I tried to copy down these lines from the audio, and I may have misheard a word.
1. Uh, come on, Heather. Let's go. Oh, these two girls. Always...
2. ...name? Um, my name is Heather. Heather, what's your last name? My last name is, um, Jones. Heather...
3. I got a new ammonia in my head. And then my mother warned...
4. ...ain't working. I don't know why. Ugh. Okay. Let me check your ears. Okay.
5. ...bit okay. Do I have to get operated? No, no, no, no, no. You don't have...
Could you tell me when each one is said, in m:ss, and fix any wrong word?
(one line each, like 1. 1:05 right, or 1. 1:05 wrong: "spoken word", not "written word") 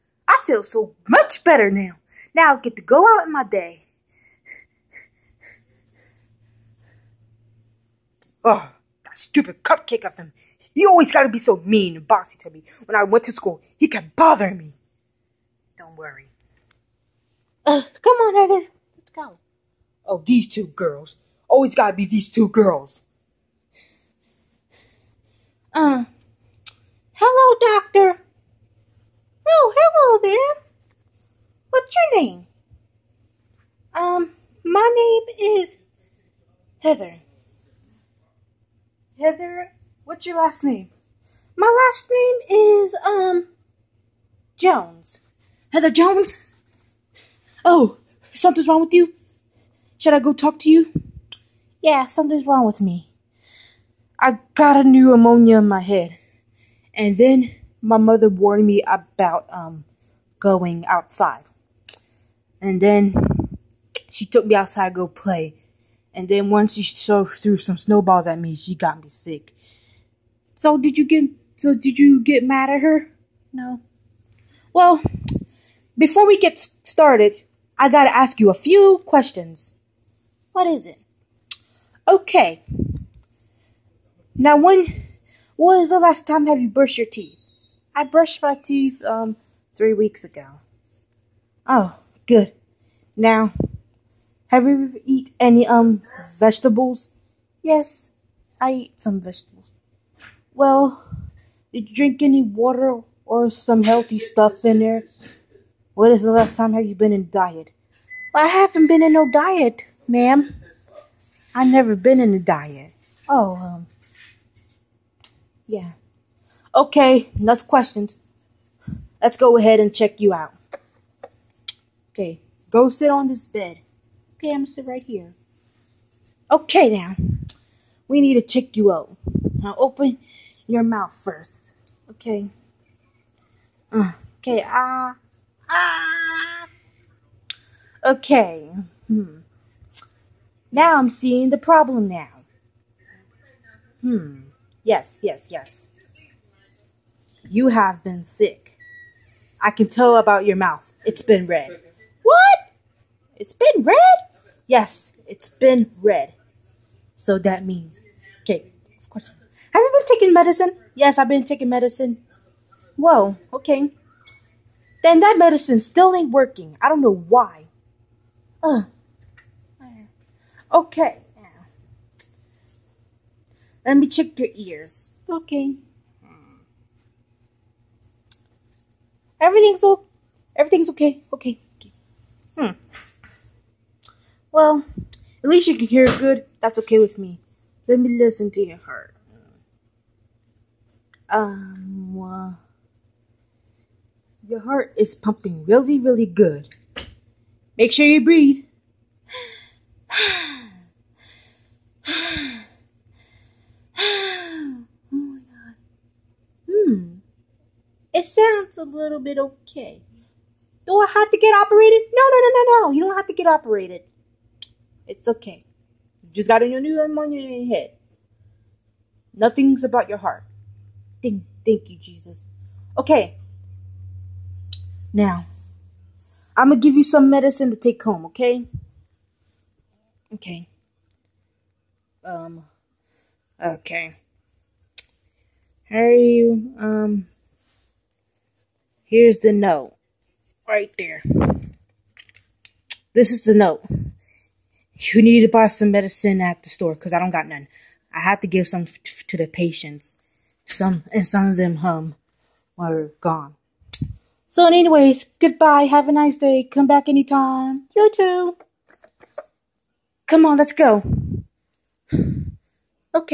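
1. 0:17 right
2. 0:32 right
3. 0:54 right
4. 2:46 right
5. 3:29 right.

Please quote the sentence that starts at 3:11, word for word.
Um, uh, your heart is pumping really, really good.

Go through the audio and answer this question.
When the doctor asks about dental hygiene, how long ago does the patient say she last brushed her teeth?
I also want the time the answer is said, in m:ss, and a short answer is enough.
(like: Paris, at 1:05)
3 weeks ago, at 1:29.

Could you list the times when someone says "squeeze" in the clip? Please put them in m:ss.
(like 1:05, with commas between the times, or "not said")
not said.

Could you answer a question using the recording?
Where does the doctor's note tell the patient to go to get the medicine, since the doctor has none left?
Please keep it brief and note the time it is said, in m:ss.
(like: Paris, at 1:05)
the store, at 4:06.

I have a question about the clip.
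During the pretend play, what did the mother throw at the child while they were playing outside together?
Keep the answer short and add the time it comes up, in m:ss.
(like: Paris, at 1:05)
snowballs, at 1:07.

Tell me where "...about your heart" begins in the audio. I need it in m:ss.
3:39.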